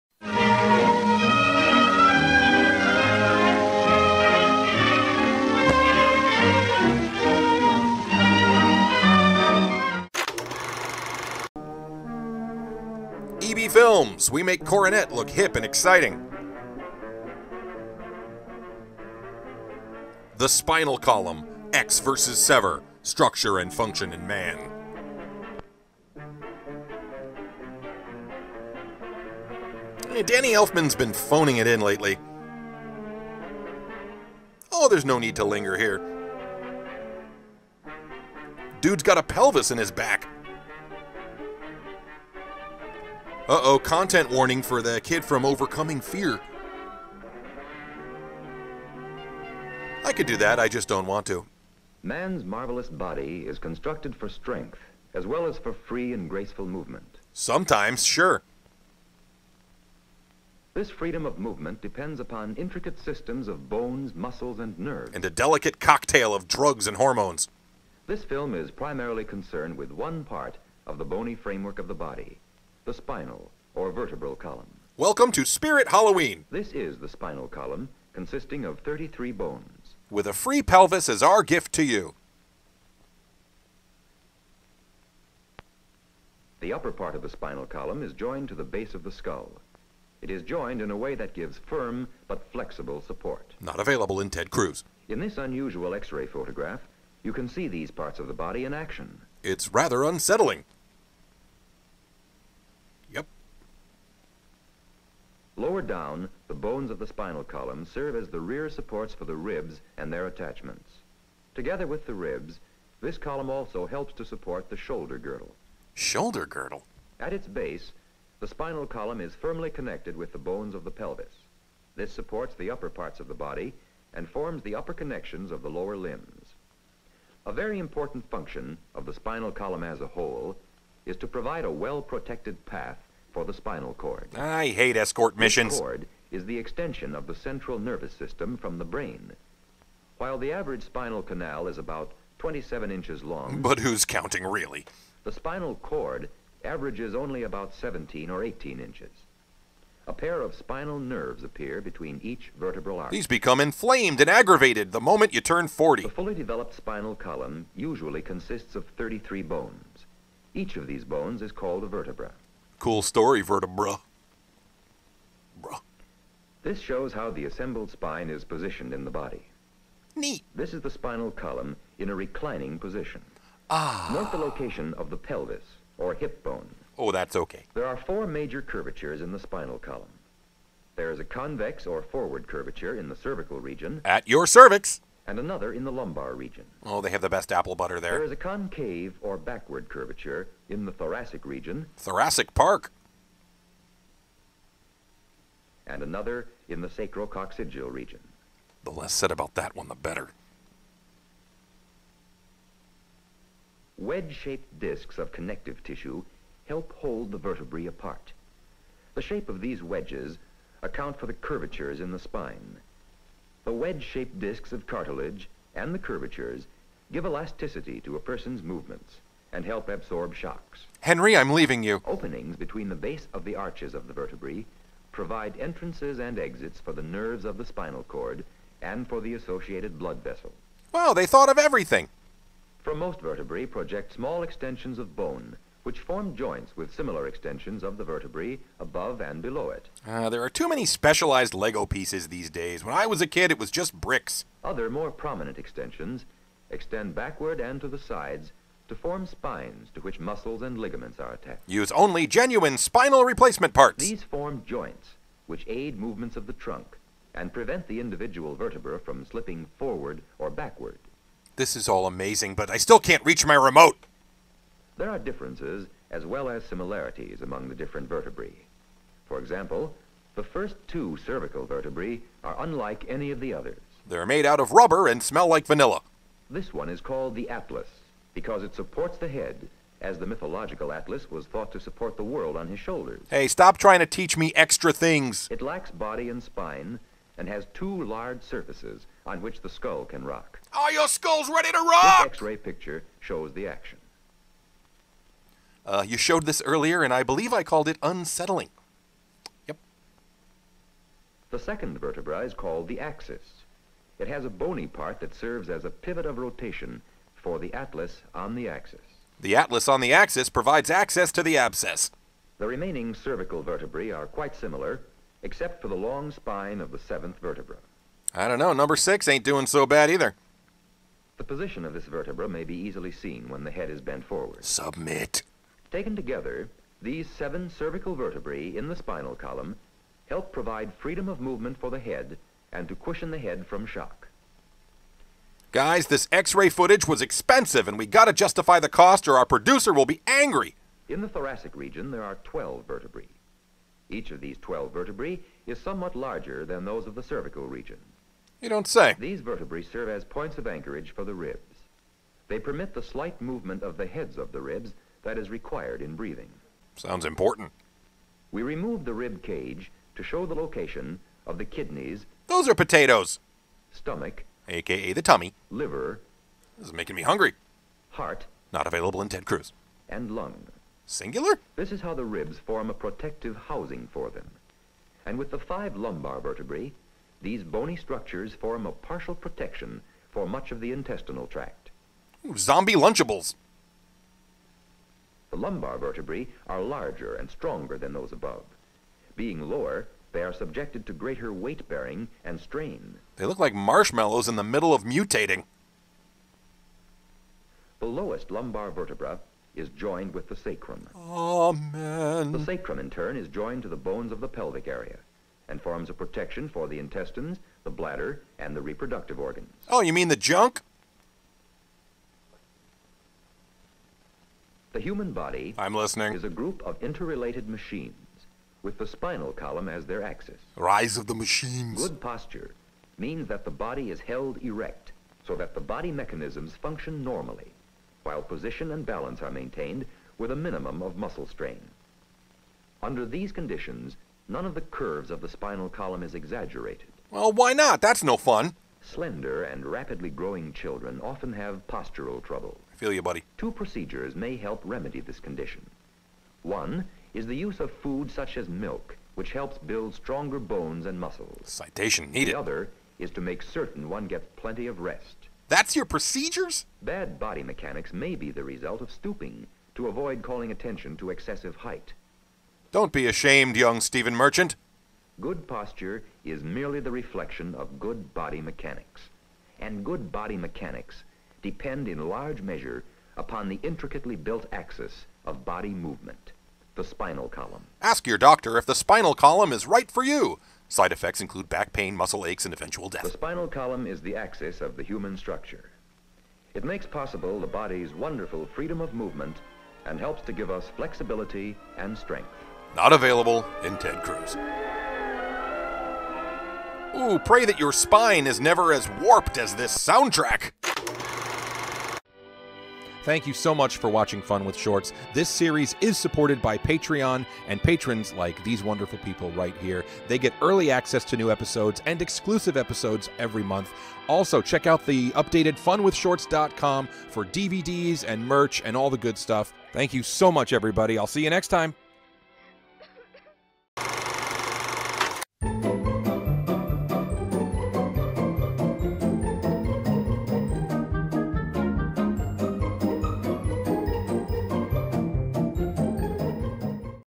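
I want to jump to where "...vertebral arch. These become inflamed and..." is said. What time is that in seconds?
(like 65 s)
152 s.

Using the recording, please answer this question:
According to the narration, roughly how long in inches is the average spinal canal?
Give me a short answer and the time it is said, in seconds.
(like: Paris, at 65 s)
27 inches, at 142 s.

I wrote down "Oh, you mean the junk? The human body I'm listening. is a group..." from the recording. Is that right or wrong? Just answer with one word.
right.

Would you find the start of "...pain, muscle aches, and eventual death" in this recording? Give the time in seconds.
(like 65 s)
481 s.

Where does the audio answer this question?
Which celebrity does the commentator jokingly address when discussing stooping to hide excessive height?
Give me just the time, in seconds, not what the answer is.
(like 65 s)
463 s.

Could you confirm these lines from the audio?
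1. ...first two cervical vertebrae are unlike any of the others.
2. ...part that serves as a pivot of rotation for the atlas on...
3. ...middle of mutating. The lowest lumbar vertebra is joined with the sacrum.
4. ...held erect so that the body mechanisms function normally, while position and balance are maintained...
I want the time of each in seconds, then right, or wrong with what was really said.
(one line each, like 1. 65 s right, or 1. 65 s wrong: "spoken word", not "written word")
1. 270 s right
2. 304 s right
3. 394 s right
4. 424 s right.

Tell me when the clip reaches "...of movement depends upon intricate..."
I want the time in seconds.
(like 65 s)
61 s.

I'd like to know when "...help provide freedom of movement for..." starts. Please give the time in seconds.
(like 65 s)
330 s.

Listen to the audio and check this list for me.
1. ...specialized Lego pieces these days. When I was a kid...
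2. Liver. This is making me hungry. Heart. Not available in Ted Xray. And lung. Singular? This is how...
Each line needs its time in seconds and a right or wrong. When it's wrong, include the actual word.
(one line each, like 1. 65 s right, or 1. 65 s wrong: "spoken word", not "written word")
1. 240 s right
2. 365 s wrong: "Cruz", not "Xray".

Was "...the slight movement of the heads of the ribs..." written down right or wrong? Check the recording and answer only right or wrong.
right.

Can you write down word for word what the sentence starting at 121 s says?
This supports the upper parts of the body and forms the upper connections of the lower limbs.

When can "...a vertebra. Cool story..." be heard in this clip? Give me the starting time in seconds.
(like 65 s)
161 s.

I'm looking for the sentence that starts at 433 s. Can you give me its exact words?
Under these conditions, none of the curves of the spinal column is exaggerated.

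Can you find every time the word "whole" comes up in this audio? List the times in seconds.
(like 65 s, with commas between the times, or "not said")
130 s.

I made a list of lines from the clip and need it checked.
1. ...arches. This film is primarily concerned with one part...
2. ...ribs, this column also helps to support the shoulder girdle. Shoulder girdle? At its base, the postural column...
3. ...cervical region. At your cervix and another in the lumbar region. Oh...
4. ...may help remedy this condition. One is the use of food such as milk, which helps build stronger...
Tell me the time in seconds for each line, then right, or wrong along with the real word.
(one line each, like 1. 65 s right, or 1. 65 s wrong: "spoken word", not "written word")
1. 66 s wrong: "hormones", not "arches"
2. 112 s wrong: "spinal", not "postural"
3. 183 s right
4. 444 s right.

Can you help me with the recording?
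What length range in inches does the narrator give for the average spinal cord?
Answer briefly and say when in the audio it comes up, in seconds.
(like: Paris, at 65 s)
17 or 18 inches, at 147 s.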